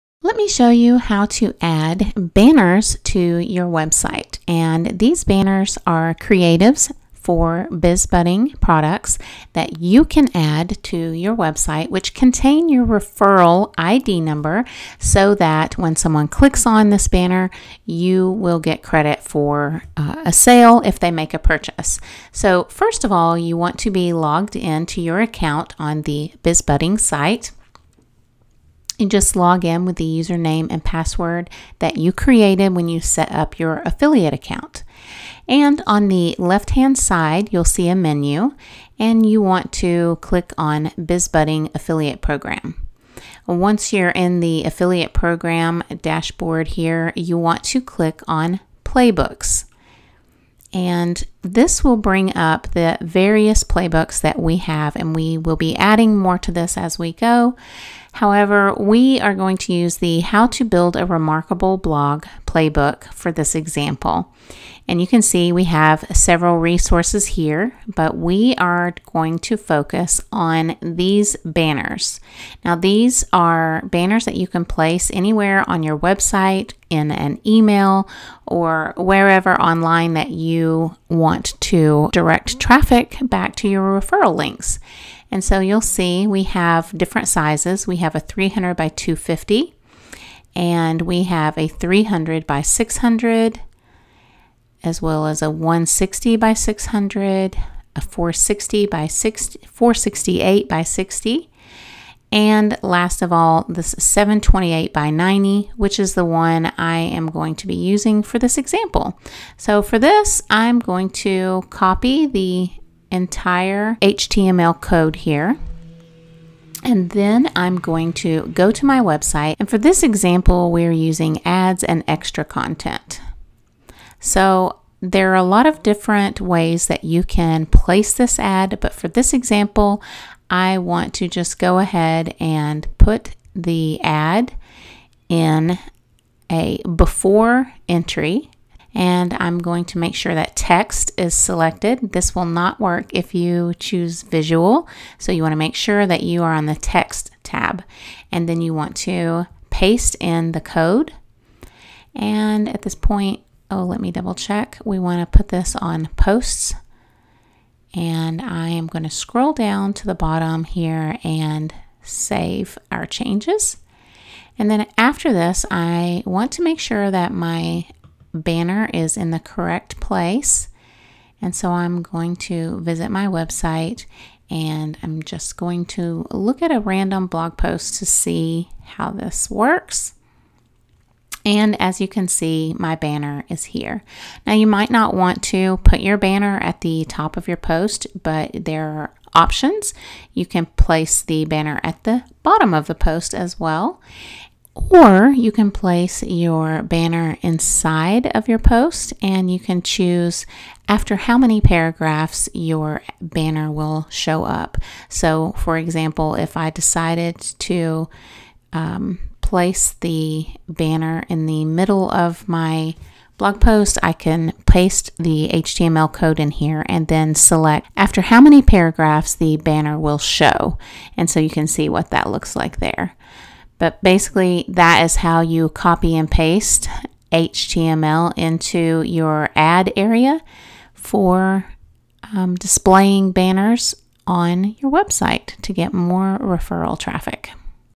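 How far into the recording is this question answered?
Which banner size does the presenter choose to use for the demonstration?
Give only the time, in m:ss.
1:43.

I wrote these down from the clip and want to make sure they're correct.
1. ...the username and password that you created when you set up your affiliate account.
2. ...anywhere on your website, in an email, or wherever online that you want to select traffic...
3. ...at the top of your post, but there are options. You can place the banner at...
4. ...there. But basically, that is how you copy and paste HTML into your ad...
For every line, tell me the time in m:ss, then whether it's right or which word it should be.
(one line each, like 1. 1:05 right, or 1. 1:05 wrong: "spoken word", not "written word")
1. 0:29 right
2. 1:15 wrong: "direct", not "select"
3. 3:06 right
4. 3:42 right.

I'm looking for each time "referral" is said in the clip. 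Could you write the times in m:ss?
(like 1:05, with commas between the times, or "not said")
0:12, 1:23, 3:56.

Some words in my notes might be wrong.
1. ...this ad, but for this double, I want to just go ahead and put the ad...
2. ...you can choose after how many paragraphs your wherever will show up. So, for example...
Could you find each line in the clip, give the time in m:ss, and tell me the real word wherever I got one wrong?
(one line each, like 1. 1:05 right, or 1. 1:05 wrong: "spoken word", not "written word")
1. 2:08 wrong: "example", not "double"
2. 3:19 wrong: "banner", not "wherever".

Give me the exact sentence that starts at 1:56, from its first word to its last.
And then I'm going to go to my website.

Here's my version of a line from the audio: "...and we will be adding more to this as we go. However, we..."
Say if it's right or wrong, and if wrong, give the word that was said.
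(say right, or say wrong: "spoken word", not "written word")
right.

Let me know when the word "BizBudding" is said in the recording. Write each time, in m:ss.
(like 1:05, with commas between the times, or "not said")
0:07, 0:26, 0:40.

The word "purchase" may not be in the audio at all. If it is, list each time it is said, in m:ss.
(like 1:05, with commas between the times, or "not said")
0:21.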